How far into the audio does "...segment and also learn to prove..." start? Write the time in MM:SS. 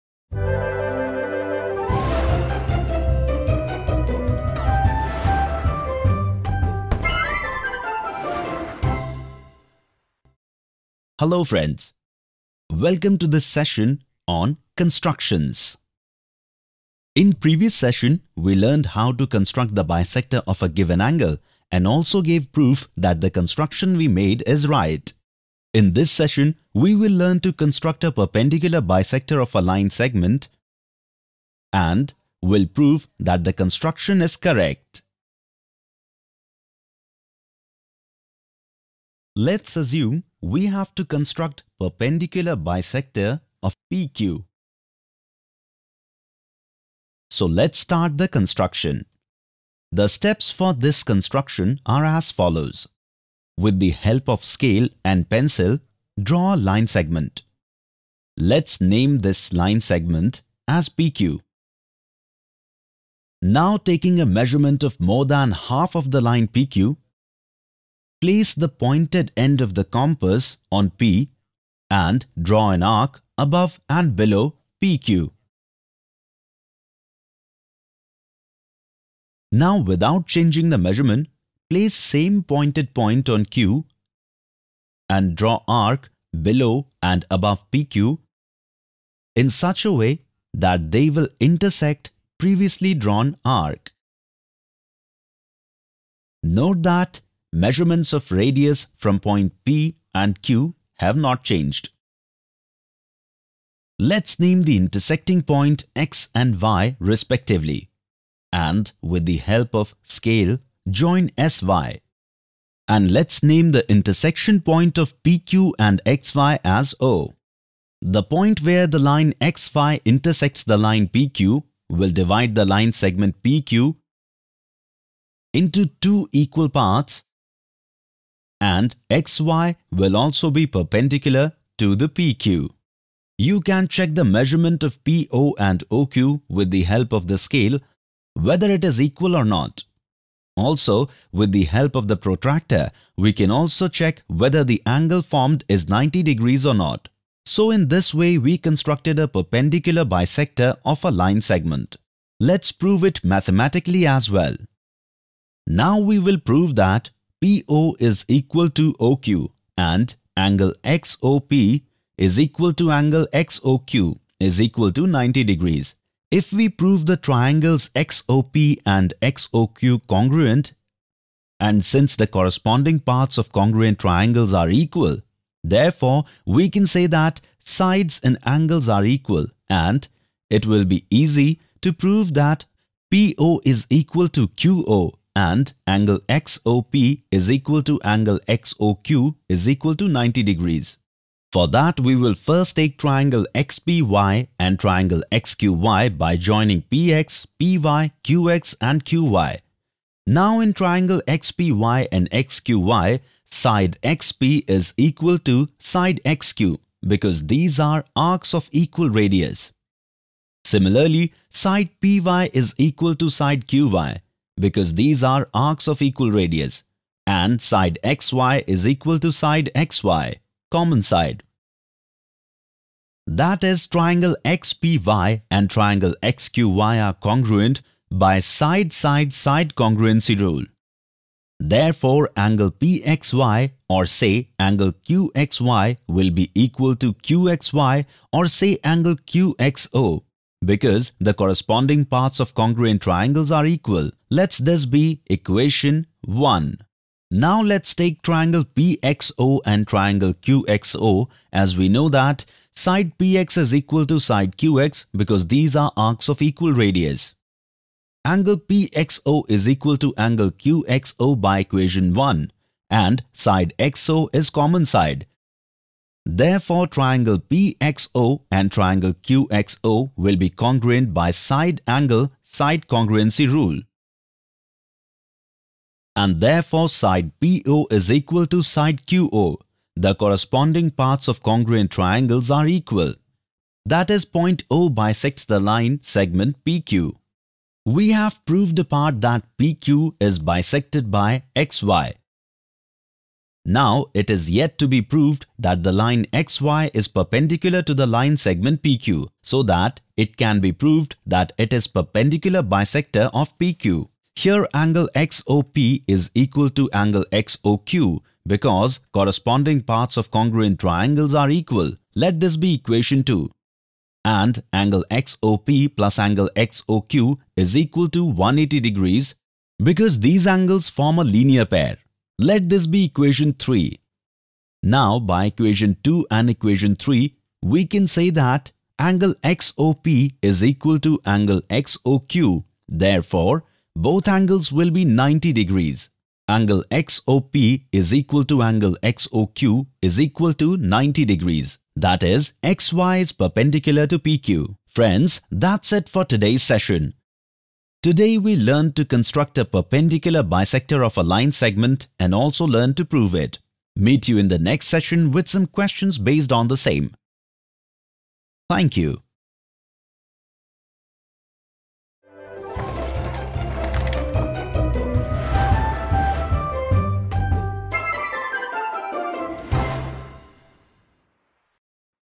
05:51.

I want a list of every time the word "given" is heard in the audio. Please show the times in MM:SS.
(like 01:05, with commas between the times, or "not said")
00:20.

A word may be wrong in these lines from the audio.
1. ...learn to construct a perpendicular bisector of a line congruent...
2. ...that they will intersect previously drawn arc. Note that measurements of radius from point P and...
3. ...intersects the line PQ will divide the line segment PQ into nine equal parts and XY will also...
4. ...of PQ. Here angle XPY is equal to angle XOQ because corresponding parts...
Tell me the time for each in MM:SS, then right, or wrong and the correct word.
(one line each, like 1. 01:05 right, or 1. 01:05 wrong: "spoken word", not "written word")
1. 00:27 wrong: "segment", not "congruent"
2. 01:30 right
3. 02:00 wrong: "two", not "nine"
4. 05:03 wrong: "XOP", not "XPY".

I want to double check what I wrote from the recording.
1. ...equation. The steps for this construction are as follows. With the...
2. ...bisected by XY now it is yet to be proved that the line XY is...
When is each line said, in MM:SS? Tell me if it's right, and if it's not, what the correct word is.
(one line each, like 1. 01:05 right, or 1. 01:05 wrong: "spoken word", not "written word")
1. 00:48 wrong: "construction", not "equation"
2. 04:50 right.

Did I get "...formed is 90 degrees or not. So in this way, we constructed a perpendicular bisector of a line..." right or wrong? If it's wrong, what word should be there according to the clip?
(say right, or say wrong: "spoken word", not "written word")
right.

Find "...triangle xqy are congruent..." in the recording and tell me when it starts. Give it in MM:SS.
03:45.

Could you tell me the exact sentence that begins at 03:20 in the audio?
Now in triangle XPY and XQY, side XP is equal to side XQ because these are arcs of equal radius.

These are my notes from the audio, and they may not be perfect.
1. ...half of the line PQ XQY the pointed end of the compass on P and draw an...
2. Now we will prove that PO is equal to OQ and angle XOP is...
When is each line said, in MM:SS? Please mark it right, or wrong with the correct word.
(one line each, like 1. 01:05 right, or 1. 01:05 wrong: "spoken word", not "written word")
1. 01:05 wrong: "Place", not "XQY"
2. 02:35 right.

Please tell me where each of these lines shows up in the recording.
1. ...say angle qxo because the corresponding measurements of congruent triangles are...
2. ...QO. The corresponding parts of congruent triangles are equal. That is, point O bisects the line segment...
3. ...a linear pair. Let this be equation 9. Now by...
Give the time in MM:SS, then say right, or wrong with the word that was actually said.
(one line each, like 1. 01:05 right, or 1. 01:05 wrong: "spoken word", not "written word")
1. 03:58 wrong: "parts", not "measurements"
2. 04:39 right
3. 05:21 wrong: "3", not "9".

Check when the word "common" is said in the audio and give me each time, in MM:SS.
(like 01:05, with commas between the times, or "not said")
03:40, 04:24.